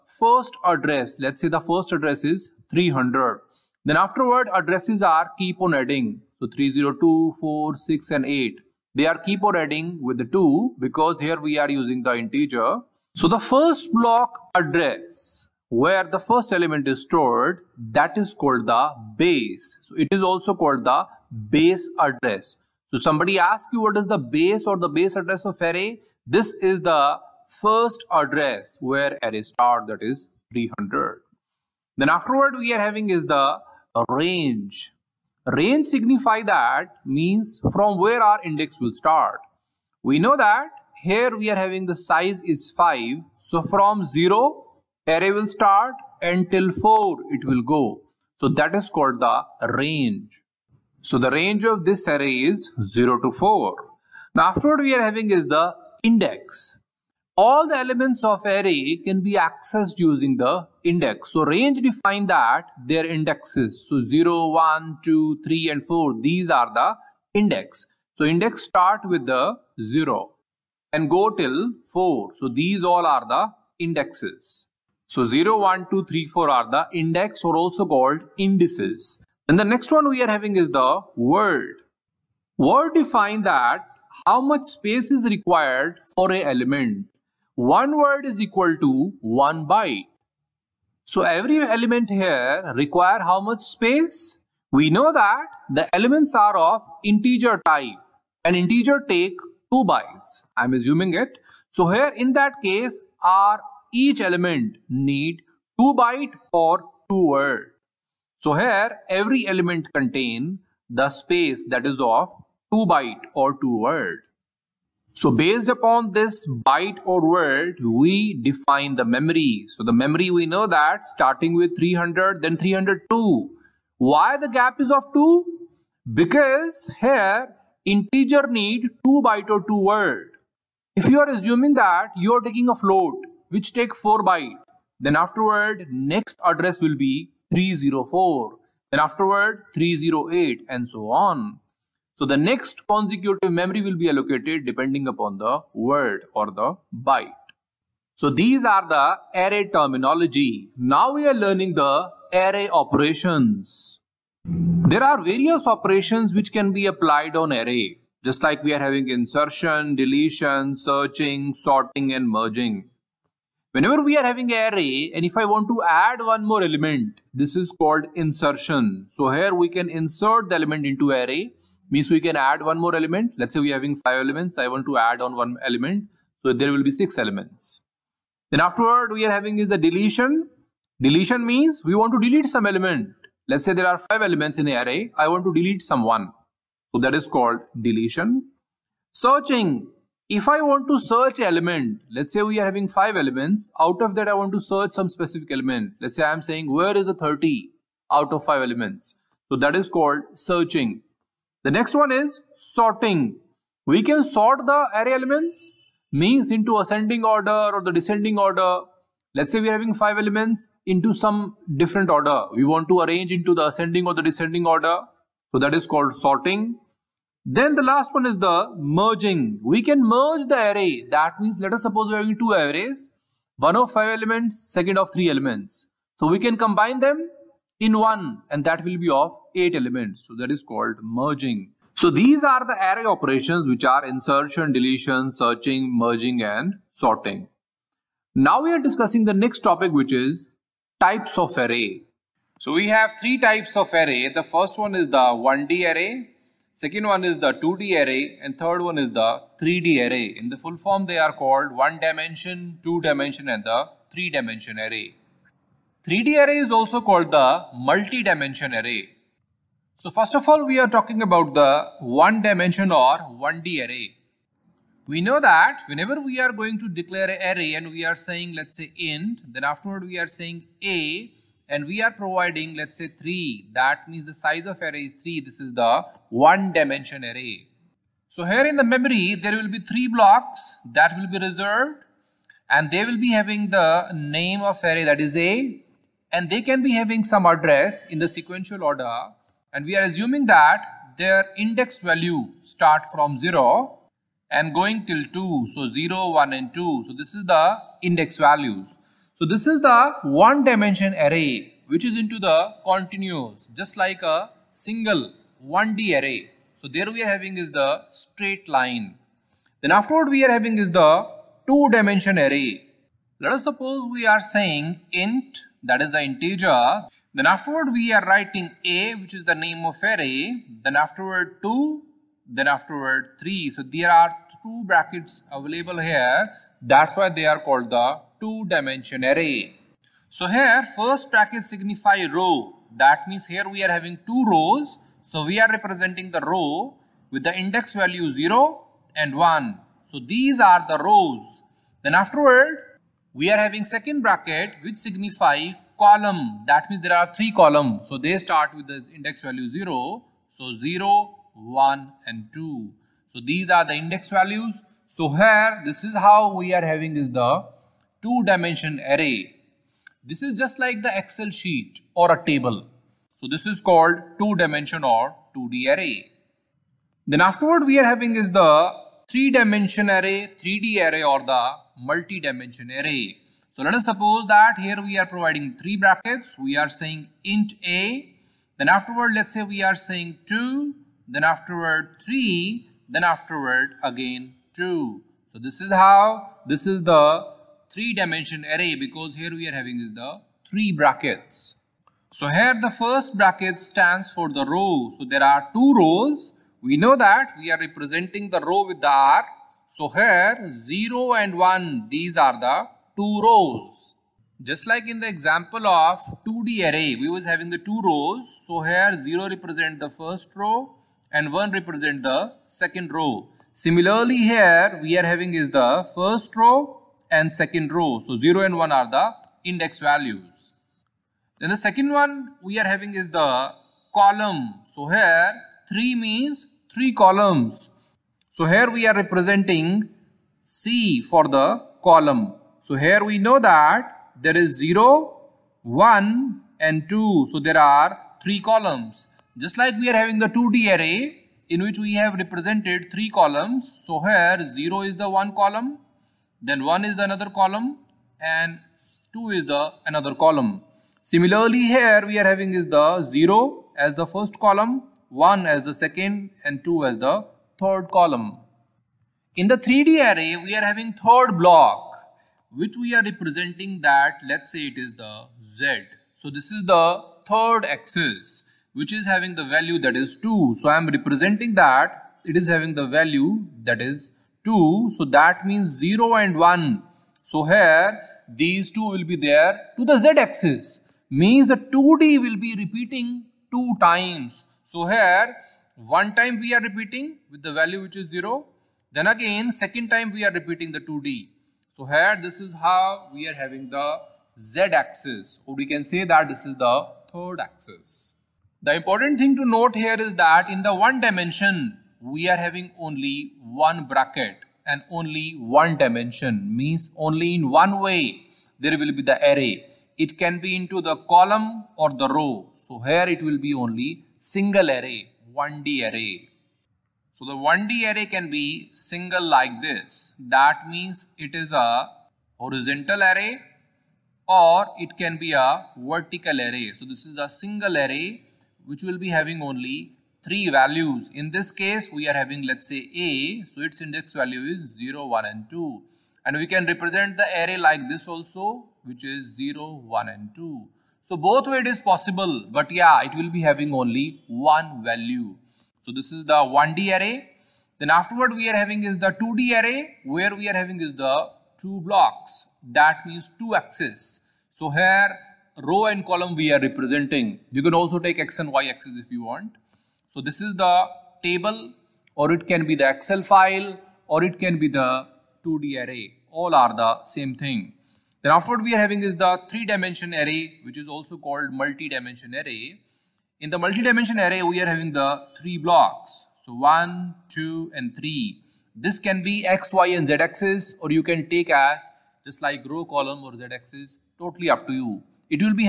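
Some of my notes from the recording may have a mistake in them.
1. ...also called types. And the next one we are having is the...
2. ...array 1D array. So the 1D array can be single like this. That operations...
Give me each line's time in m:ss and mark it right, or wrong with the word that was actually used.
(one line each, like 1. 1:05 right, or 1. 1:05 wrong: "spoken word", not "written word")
1. 1:17 wrong: "indices", not "types"
2. 8:34 wrong: "means", not "operations".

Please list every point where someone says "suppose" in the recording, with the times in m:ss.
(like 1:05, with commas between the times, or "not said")
3:41, 5:13, 6:14.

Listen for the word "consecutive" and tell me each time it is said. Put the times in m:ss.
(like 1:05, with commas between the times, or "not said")
2:22.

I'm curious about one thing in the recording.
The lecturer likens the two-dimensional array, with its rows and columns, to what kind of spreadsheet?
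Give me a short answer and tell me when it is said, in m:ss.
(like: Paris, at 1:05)
Excel sheet, at 6:01.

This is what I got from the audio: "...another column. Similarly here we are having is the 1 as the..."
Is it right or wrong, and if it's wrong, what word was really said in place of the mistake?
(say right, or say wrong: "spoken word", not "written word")
wrong: "0", not "1".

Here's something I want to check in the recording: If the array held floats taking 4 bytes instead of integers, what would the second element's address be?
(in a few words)
304.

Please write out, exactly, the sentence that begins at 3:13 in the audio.
Out of that, I want to search some specific element.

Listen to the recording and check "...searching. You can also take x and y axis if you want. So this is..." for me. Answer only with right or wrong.
wrong.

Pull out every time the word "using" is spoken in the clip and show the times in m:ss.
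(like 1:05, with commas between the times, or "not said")
0:11, 0:59.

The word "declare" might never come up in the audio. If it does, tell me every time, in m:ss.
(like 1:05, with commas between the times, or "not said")
4:26.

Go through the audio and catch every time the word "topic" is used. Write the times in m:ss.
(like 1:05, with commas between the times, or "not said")
3:59.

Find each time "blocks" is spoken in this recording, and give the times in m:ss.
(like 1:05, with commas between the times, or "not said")
0:13, 4:40, 7:41, 9:12, 9:35.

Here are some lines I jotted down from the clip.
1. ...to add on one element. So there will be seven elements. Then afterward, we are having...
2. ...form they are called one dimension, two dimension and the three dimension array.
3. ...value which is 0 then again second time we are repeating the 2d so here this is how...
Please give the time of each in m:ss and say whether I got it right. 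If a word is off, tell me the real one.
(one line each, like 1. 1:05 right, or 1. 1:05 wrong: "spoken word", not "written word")
1. 2:54 wrong: "six", not "seven"
2. 4:10 right
3. 8:07 right.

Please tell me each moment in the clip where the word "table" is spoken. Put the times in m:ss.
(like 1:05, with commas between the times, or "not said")
6:02, 9:21.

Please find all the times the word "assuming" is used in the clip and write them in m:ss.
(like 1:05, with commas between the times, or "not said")
1:40, 2:11, 4:50.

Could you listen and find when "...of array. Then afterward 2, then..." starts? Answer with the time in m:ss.
5:19.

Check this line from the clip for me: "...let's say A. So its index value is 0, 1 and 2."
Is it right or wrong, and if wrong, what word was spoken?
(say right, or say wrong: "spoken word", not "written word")
right.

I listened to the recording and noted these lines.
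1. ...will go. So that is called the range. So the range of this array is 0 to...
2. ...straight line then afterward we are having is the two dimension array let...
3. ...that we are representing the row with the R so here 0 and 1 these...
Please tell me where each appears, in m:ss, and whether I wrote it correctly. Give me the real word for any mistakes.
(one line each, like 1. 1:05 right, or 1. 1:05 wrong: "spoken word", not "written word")
1. 0:47 right
2. 5:08 right
3. 6:37 right.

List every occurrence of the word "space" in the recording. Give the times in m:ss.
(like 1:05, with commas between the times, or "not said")
1:24, 1:33, 1:51.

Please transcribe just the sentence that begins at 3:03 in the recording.
Let's say there are five elements in an array.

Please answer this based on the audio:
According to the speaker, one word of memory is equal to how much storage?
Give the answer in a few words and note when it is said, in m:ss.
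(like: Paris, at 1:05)
one byte, at 1:29.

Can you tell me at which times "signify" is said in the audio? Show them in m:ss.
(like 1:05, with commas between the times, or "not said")
0:35, 5:31, 5:44.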